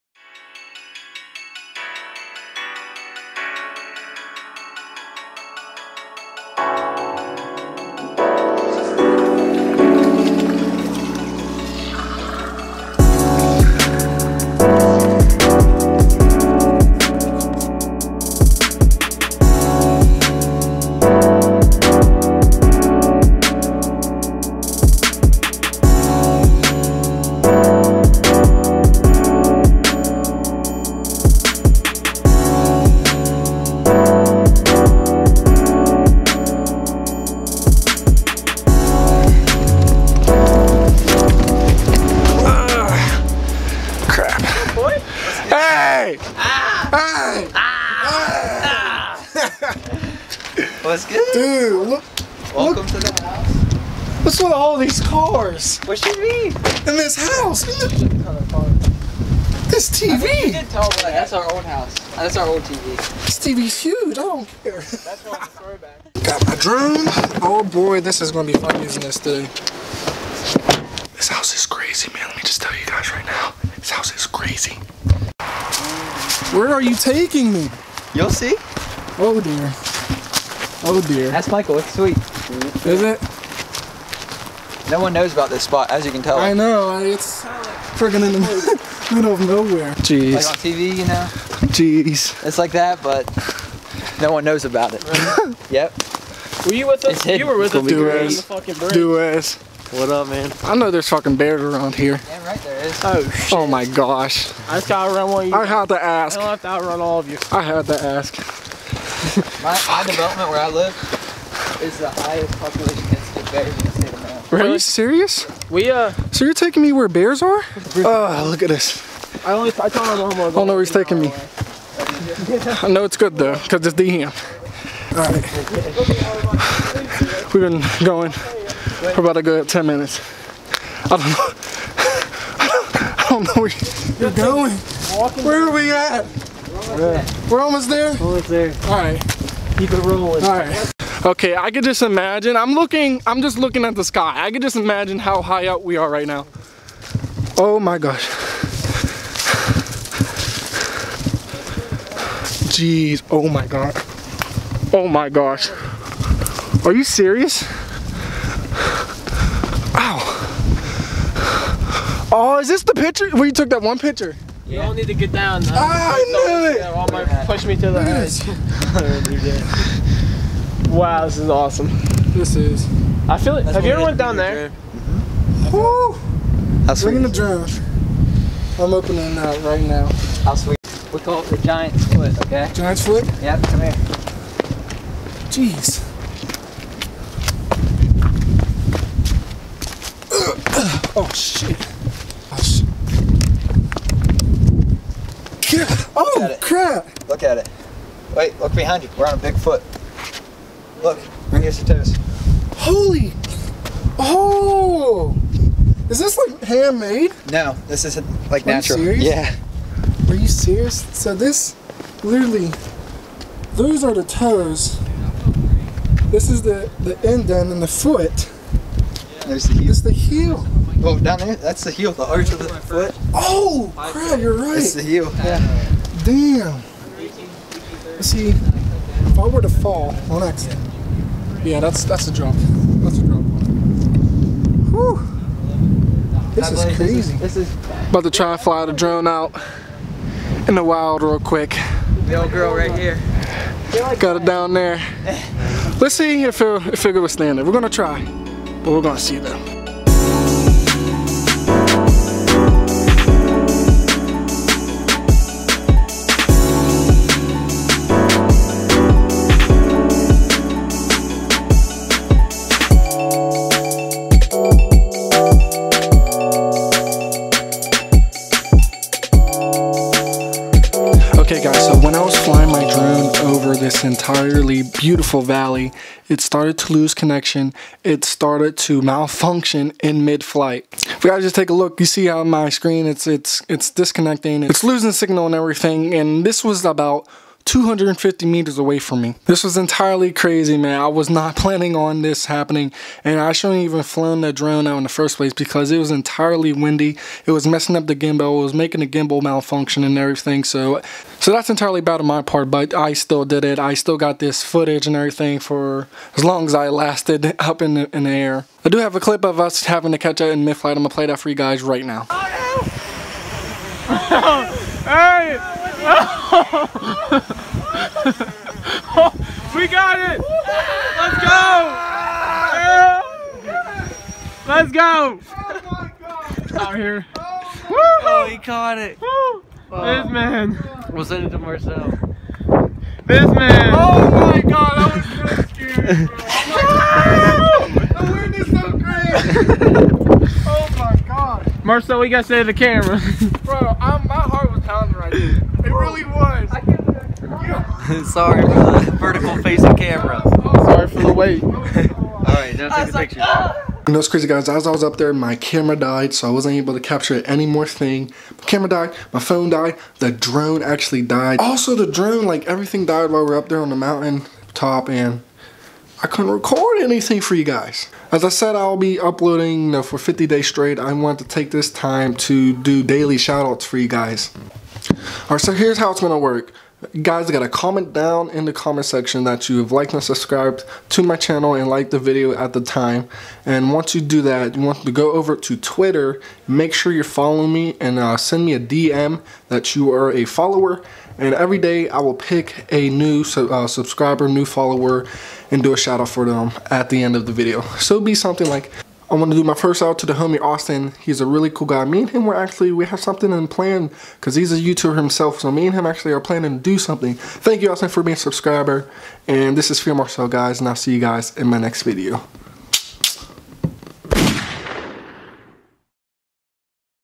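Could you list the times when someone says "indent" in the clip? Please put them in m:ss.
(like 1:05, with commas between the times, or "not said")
3:37.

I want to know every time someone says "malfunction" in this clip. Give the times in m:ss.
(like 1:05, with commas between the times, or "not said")
4:39, 4:59.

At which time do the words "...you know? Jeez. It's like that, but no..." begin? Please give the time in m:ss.
1:30.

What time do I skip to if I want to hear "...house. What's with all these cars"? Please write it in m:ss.
0:53.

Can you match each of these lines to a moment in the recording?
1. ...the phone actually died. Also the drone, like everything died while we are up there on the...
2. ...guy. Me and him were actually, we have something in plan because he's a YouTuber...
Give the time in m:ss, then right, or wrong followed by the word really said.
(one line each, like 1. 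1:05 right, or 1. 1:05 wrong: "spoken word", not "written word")
1. 6:00 wrong: "drone", not "phone"
2. 6:41 right.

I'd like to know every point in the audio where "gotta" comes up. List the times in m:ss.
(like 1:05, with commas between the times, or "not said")
1:44, 5:42, 6:17.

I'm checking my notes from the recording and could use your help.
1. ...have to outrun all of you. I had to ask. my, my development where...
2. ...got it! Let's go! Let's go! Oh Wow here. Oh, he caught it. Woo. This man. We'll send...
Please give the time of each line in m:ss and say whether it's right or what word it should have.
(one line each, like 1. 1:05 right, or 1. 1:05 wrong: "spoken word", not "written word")
1. 1:46 right
2. 5:19 wrong: "Out", not "Wow".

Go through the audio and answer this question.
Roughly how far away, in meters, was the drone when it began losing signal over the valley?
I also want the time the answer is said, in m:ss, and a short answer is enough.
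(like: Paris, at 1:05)
250 meters, at 4:47.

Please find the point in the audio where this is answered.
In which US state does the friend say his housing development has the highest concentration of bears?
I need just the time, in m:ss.
1:54.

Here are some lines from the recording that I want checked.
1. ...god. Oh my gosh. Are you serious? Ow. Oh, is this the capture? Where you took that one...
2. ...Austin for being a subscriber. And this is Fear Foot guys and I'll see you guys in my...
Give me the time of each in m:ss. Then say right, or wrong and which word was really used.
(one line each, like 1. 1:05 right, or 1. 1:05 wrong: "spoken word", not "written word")
1. 2:33 wrong: "picture", not "capture"
2. 6:47 wrong: "Marcel", not "Foot".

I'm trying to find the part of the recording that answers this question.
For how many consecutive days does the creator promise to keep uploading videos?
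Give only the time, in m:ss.
6:10.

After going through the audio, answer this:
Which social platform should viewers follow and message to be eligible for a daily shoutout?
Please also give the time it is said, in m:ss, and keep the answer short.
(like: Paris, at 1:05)
Twitter, at 6:25.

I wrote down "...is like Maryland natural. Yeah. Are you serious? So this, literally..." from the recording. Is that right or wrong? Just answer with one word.
wrong.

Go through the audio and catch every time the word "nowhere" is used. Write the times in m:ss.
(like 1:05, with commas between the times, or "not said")
1:29.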